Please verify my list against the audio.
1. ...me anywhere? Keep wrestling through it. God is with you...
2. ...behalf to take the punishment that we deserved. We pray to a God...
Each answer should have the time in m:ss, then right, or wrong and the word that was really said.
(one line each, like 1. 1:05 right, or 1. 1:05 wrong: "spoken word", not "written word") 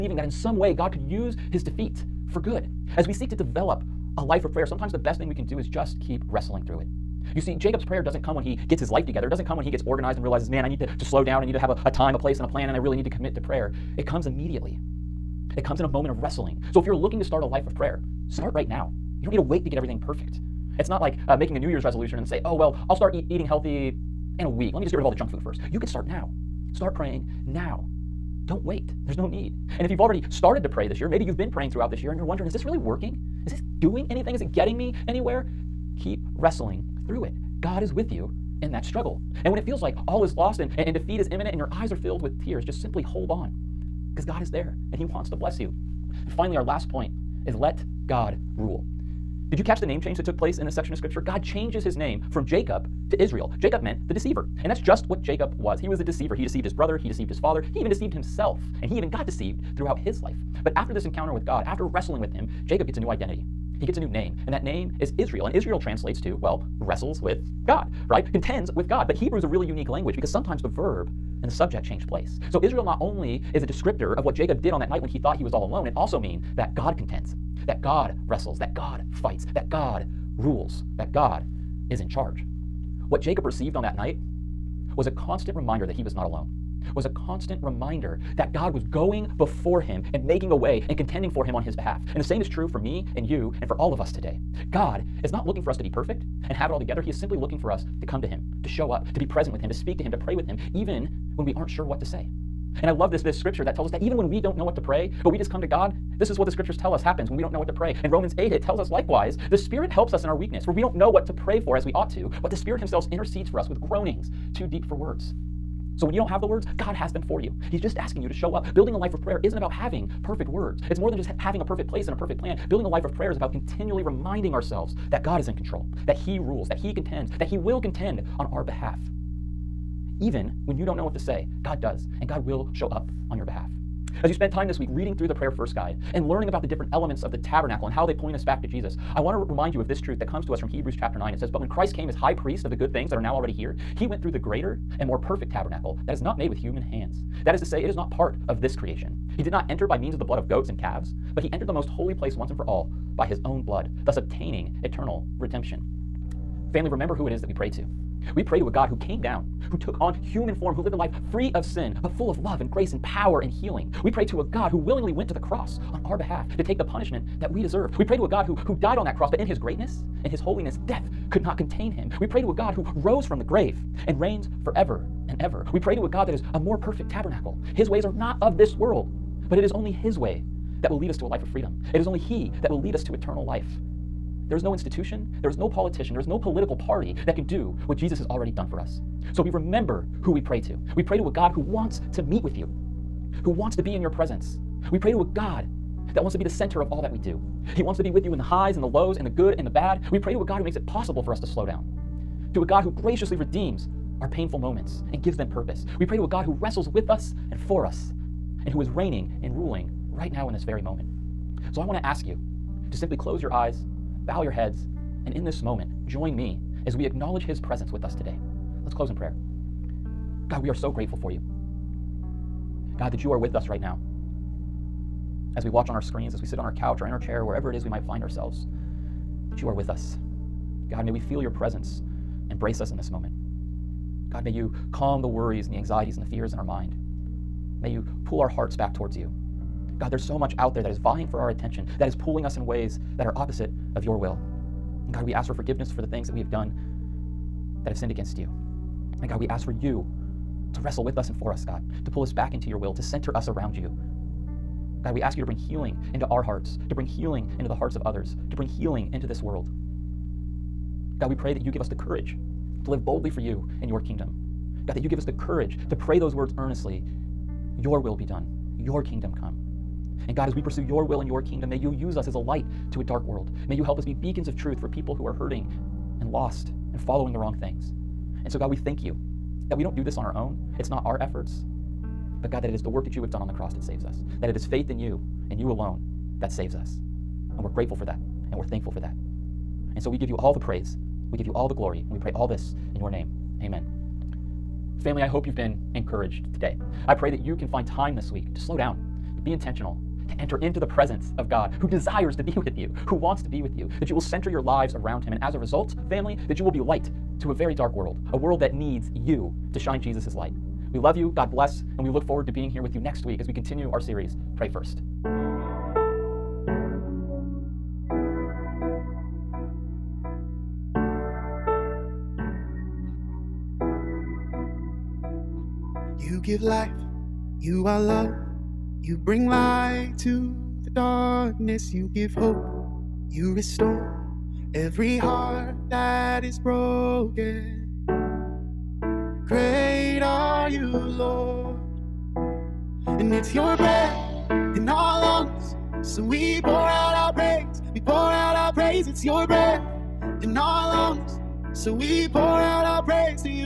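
1. 0:34 right
2. 2:46 right.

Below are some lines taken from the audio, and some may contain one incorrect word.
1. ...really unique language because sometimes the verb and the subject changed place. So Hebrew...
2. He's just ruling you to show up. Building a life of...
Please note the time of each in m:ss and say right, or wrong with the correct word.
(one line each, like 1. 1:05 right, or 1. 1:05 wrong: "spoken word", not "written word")
1. 1:09 wrong: "Israel", not "Hebrew"
2. 1:57 wrong: "asking", not "ruling".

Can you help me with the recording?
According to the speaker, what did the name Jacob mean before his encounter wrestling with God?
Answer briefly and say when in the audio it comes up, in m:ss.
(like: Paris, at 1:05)
The deceiver, at 0:54.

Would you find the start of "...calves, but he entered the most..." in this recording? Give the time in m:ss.
2:30.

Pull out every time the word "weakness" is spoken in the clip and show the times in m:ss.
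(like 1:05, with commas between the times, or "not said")
1:50.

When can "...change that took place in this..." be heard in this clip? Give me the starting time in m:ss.
0:50.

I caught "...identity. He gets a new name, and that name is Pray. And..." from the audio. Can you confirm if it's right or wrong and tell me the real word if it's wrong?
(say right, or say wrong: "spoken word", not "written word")
wrong: "Israel", not "Pray".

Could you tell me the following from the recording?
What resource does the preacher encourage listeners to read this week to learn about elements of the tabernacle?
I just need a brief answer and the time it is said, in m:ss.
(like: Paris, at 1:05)
Pray First Guide, at 2:15.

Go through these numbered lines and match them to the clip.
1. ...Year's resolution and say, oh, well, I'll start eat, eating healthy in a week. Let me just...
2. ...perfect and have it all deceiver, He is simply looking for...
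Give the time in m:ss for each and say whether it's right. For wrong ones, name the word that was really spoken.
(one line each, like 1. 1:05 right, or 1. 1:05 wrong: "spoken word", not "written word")
1. 0:21 right
2. 1:35 wrong: "together", not "deceiver".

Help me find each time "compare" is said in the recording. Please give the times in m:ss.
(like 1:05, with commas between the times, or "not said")
not said.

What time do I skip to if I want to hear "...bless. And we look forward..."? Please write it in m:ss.
5:11.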